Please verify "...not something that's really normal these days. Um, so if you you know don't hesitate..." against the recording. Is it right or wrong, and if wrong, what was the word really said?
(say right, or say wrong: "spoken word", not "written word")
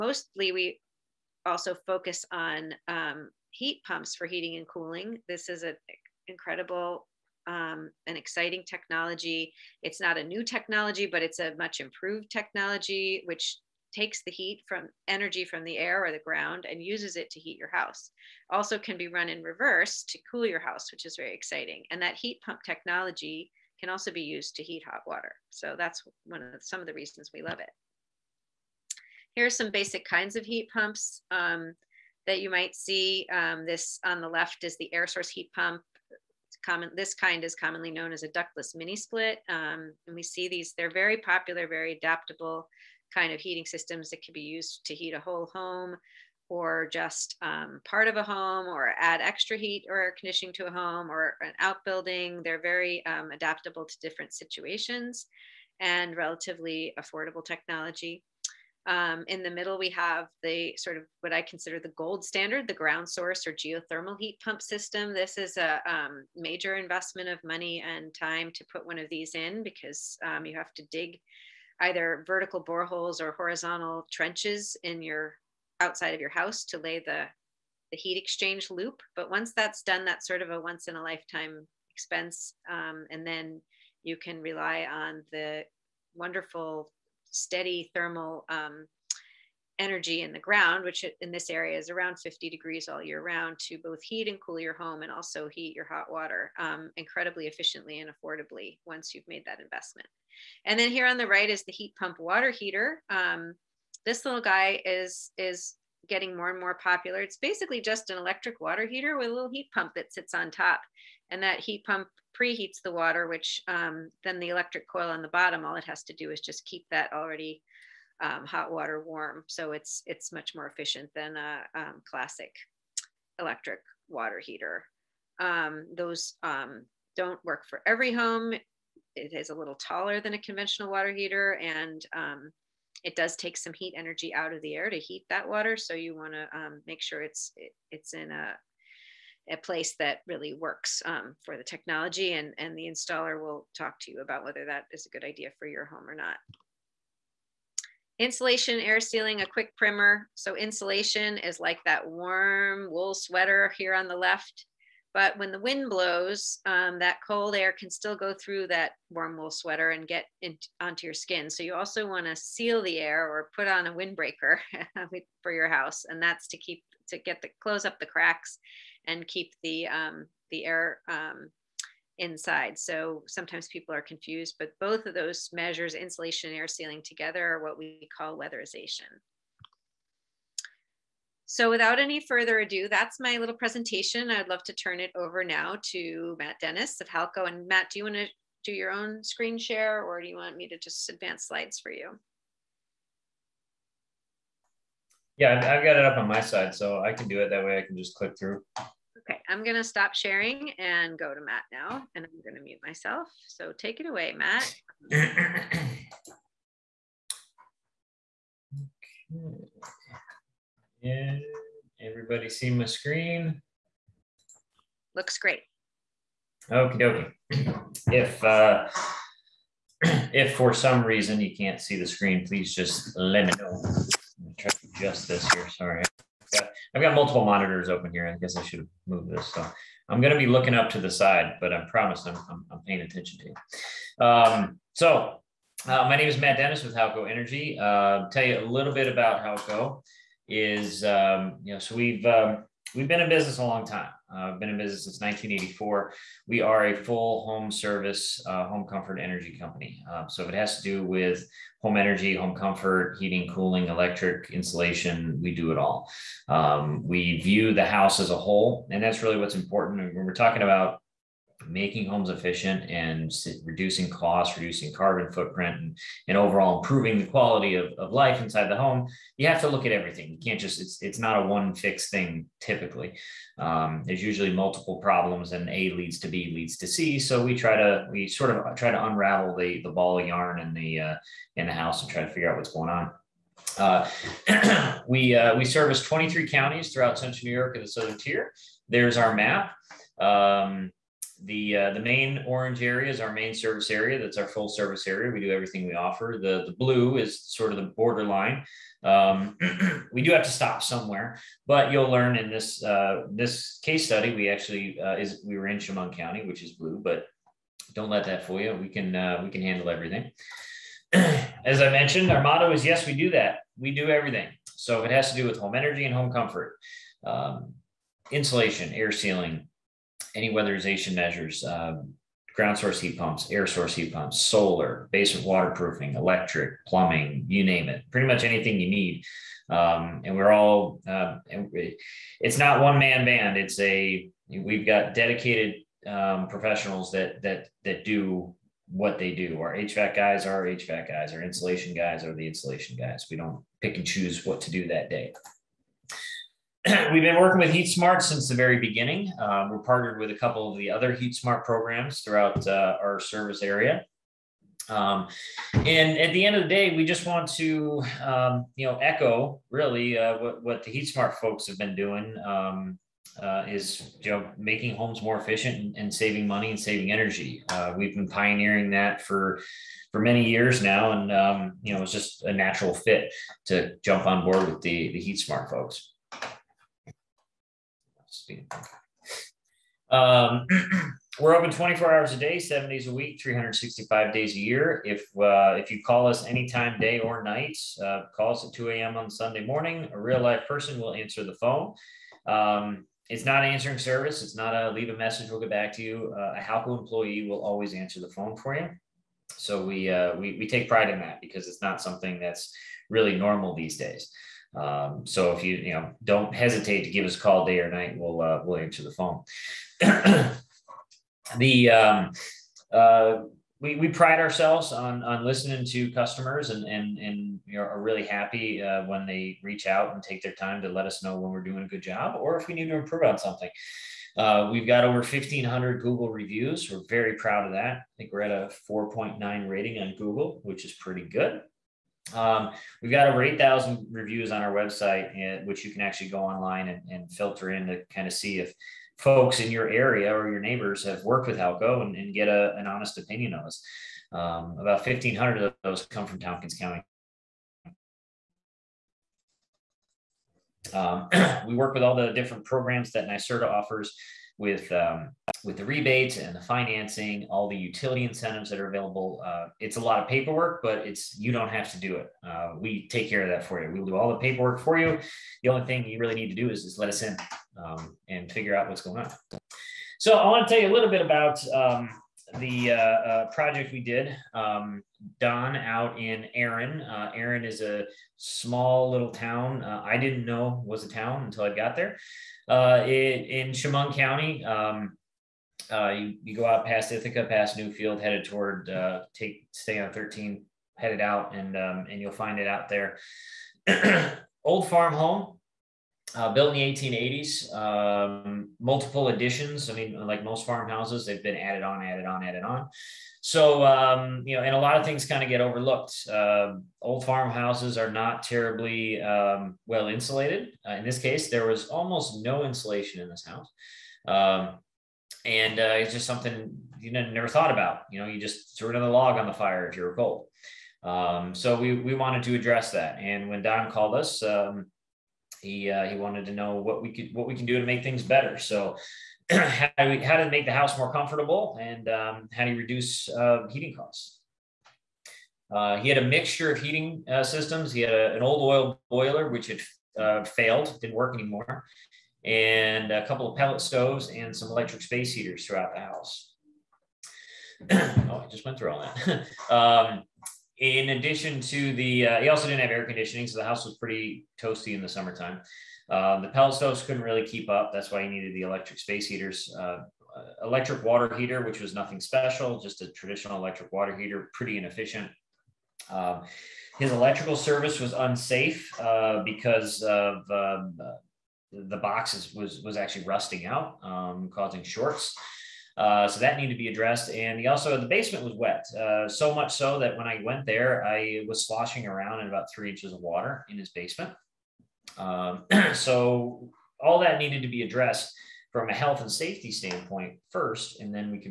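right.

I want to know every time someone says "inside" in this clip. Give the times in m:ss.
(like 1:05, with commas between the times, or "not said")
2:52, 4:28.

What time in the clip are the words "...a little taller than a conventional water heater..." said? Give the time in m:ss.
2:09.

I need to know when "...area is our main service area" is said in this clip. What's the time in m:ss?
4:52.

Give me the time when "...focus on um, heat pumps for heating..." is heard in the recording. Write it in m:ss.
0:01.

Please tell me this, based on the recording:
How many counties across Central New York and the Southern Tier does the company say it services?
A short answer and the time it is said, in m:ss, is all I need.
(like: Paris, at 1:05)
23, at 4:46.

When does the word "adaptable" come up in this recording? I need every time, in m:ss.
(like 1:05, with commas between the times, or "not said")
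0:41, 0:53.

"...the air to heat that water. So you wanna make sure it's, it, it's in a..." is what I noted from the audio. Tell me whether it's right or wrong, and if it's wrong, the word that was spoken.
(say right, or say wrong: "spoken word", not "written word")
right.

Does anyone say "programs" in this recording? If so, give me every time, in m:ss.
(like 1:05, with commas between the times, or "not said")
5:51, 7:32.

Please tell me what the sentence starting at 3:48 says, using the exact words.
I guess I should have moved this.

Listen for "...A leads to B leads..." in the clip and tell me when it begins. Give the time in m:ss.
4:35.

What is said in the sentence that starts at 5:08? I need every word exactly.
We can uh, we can handle everything.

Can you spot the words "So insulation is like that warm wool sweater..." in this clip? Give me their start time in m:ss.
2:30.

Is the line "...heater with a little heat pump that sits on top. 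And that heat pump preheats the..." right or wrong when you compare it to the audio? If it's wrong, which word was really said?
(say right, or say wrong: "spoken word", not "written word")
right.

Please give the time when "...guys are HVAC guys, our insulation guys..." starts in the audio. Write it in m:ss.
5:40.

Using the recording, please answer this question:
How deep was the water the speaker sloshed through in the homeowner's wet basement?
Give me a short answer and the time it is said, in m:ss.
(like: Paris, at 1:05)
about 3 inches, at 9:42.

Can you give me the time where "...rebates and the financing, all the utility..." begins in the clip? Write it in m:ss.
7:35.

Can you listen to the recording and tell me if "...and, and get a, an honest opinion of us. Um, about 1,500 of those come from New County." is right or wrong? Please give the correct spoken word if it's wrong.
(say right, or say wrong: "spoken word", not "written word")
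wrong: "Tompkins", not "New".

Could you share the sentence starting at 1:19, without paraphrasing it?
But once that's done, that's sort of a once in a lifetime expense.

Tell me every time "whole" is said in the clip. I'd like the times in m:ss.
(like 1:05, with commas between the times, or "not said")
0:45, 4:18.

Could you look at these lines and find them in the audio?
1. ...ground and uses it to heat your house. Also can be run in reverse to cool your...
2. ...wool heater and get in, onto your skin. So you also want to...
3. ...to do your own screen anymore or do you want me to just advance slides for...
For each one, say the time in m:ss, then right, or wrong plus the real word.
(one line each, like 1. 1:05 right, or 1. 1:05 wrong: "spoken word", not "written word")
1. 0:16 right
2. 2:39 wrong: "sweater", not "heater"
3. 3:08 wrong: "share", not "anymore".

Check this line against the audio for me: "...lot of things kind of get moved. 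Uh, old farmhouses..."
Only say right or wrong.
wrong.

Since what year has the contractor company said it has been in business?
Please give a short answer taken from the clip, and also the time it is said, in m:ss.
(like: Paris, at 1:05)
1984, at 4:05.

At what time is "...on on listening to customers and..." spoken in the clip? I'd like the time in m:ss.
6:54.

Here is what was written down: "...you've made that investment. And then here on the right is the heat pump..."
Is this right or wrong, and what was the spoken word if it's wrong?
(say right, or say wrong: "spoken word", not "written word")
right.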